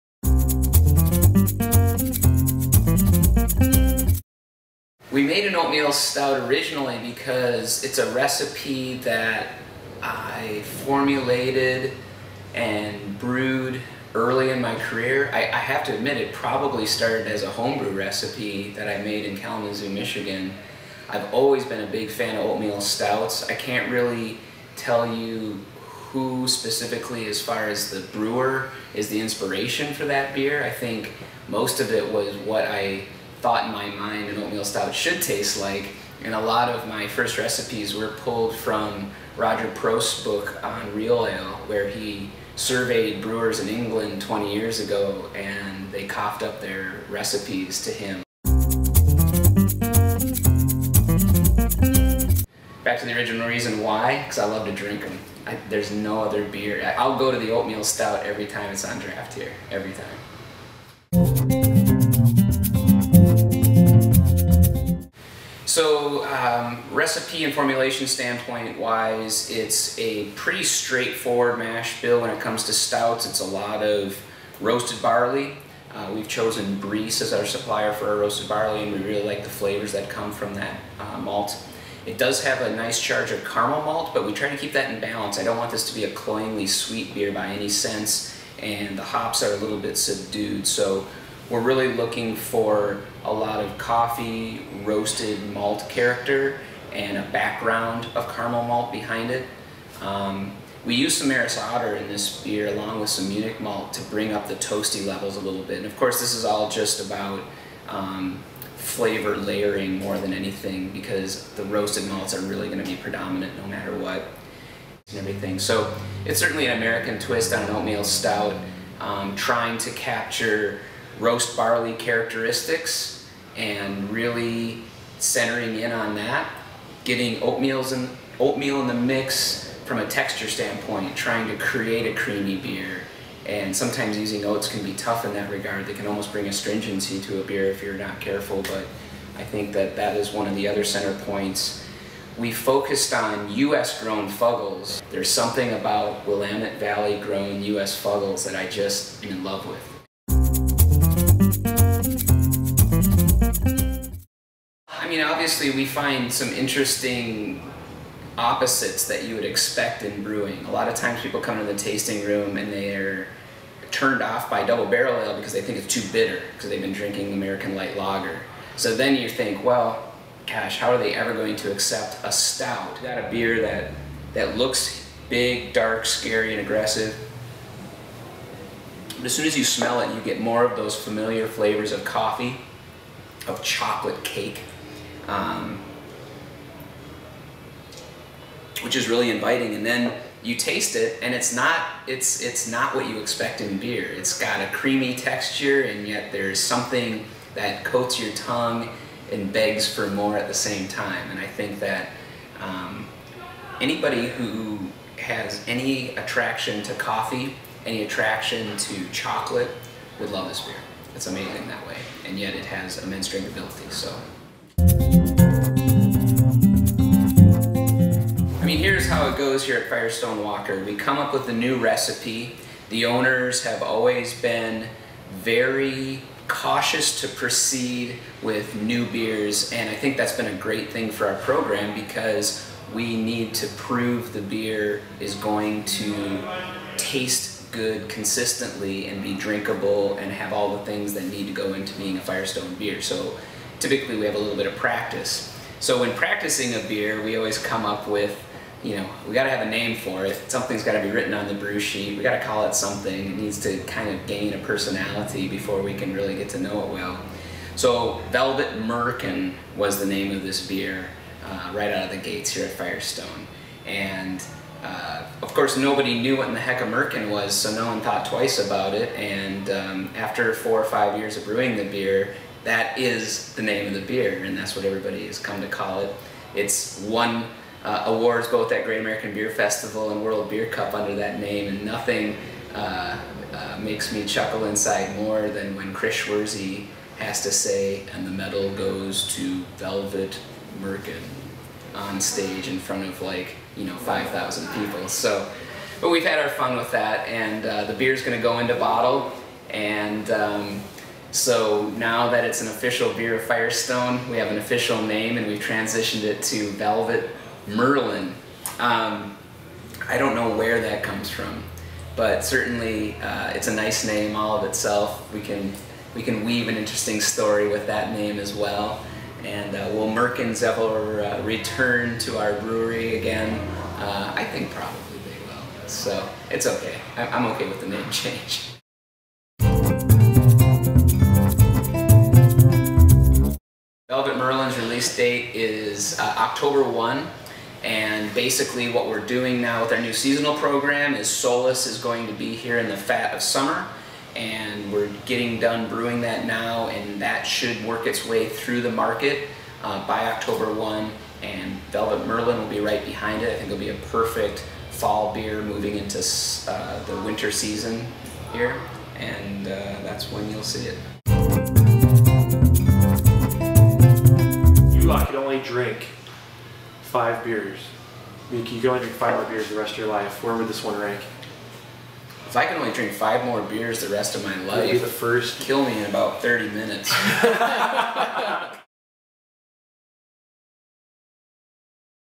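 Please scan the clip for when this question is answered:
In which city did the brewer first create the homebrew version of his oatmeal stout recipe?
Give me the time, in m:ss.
0:19.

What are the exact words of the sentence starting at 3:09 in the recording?
And then you taste it, and it's not it's it's not what you expect in beer.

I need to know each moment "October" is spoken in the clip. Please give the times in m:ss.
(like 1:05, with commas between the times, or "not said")
5:36, 5:50.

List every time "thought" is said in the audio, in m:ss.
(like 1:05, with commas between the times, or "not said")
0:33, 4:28.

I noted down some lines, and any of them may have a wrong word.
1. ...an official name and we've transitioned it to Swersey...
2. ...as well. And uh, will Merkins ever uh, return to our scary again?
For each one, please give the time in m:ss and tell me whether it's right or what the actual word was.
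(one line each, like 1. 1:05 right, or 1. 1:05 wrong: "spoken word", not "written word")
1. 5:04 wrong: "Velvet", not "Swersey"
2. 5:18 wrong: "brewery", not "scary".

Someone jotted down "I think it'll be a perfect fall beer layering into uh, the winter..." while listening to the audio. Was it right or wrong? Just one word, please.
wrong.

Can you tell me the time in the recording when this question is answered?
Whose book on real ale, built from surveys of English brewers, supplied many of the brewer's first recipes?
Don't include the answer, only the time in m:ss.
0:39.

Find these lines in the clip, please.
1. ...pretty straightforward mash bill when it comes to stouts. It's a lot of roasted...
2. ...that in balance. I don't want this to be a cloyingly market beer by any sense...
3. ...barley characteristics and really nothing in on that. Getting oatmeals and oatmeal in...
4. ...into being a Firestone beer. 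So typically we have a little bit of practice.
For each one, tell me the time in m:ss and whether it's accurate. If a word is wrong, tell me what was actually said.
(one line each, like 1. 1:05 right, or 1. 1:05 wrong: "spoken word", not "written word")
1. 1:10 right
2. 1:24 wrong: "sweet", not "market"
3. 2:01 wrong: "centering", not "nothing"
4. 4:01 right.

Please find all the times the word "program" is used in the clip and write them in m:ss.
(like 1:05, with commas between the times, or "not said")
3:51, 5:40.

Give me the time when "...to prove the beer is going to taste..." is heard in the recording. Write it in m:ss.
3:53.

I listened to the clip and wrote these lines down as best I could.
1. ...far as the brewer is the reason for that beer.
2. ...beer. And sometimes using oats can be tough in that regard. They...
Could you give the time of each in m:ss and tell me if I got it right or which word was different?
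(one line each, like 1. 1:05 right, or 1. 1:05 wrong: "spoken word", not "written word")
1. 0:27 wrong: "inspiration", not "reason"
2. 2:12 right.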